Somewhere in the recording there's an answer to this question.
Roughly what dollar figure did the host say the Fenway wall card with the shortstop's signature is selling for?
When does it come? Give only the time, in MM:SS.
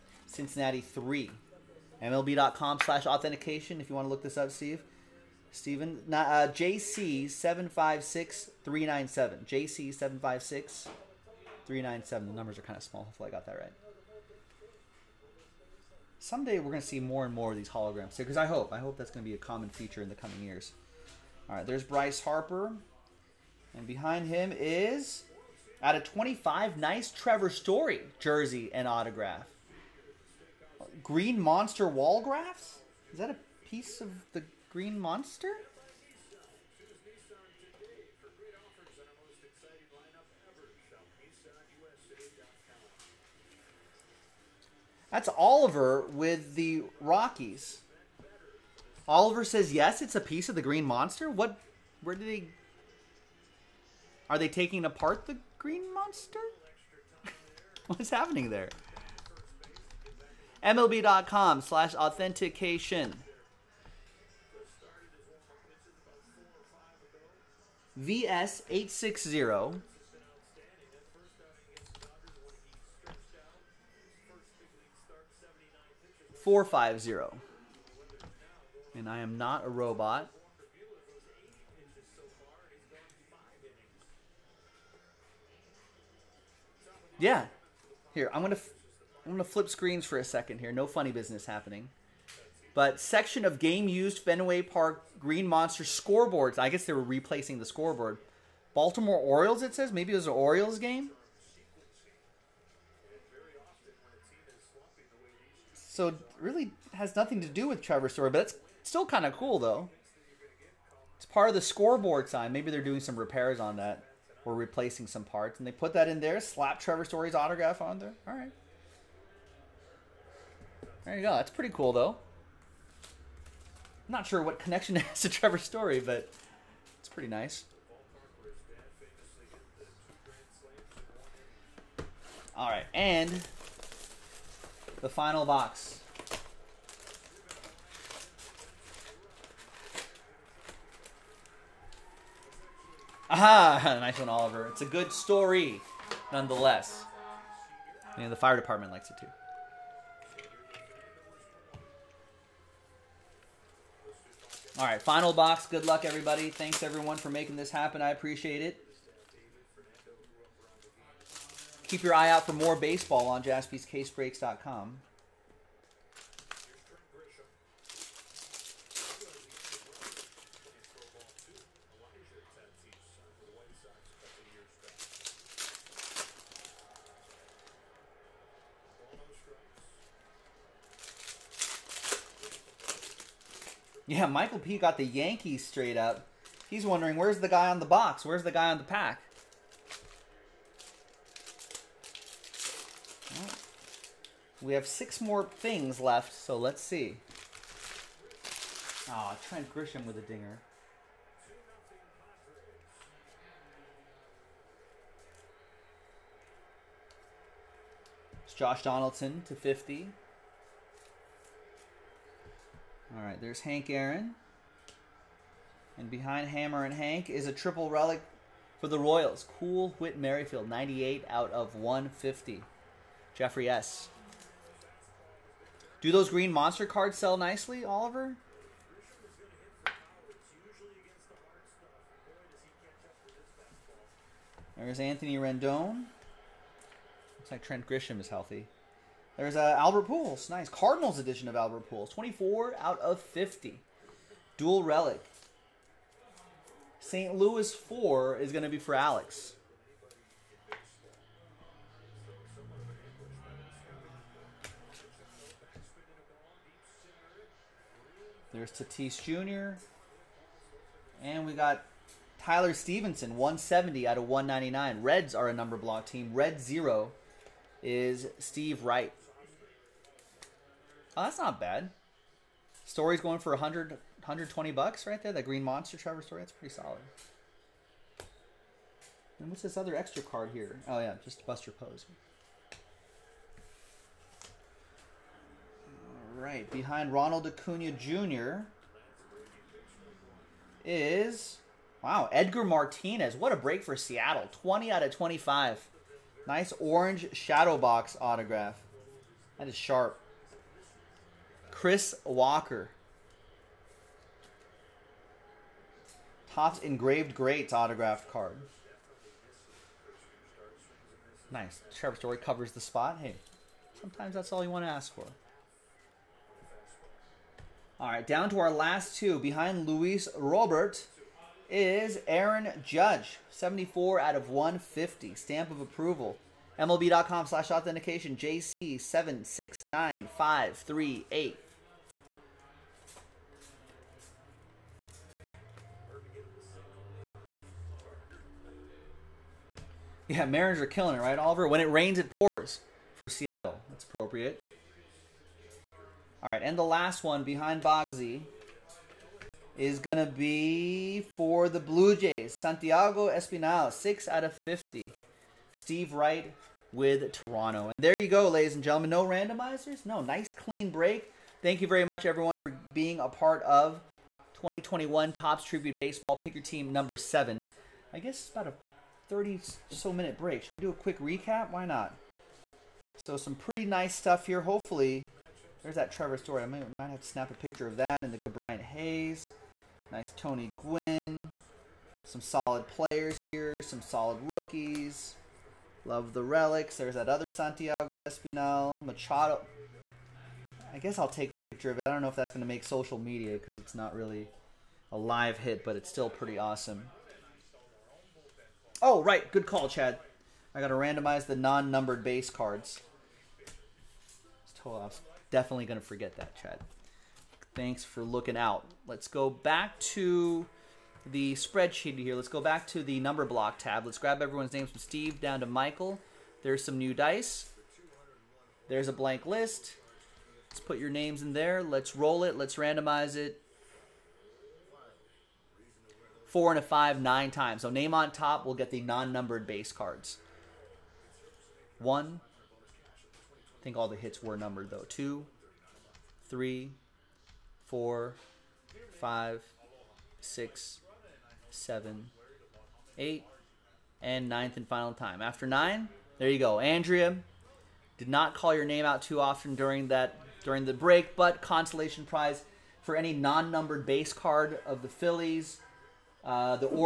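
04:33.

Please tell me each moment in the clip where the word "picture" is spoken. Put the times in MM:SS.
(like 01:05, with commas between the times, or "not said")
06:17, 06:31.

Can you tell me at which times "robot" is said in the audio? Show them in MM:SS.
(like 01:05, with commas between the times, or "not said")
01:19.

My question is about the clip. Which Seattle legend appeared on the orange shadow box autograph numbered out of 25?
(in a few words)
Edgar Martinez.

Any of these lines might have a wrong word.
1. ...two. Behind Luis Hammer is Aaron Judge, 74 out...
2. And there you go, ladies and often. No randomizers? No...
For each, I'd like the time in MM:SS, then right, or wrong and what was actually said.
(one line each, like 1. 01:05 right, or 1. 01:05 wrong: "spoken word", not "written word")
1. 05:19 wrong: "Robert", not "Hammer"
2. 05:57 wrong: "gentlemen", not "often".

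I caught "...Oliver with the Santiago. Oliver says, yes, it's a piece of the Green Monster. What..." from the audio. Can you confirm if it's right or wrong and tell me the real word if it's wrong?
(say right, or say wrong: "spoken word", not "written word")
wrong: "Rockies", not "Santiago".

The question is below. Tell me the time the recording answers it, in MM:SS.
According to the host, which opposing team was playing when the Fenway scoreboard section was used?
01:38.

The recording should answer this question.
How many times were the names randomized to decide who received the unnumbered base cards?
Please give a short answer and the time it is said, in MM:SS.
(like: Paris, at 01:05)
9, at 07:07.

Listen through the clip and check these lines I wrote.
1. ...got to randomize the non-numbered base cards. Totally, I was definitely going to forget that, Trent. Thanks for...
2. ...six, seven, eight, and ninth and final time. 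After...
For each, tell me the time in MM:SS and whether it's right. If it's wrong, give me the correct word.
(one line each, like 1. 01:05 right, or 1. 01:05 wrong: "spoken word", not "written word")
1. 06:40 wrong: "Chad", not "Trent"
2. 07:20 right.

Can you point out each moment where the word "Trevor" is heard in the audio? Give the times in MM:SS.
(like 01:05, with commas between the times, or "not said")
00:27, 01:47, 01:56, 02:05, 04:35, 05:11, 06:16.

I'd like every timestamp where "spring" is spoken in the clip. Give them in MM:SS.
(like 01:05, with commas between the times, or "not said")
not said.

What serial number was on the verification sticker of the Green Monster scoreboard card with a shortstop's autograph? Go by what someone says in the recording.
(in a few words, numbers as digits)
VS860450.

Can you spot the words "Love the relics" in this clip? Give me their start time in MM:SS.
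06:26.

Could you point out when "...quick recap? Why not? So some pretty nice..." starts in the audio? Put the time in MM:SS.
06:10.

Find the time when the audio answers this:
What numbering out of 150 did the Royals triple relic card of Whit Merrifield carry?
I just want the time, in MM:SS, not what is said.
03:40.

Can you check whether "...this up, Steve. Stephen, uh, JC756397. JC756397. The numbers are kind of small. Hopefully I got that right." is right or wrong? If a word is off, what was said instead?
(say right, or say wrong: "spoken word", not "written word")
right.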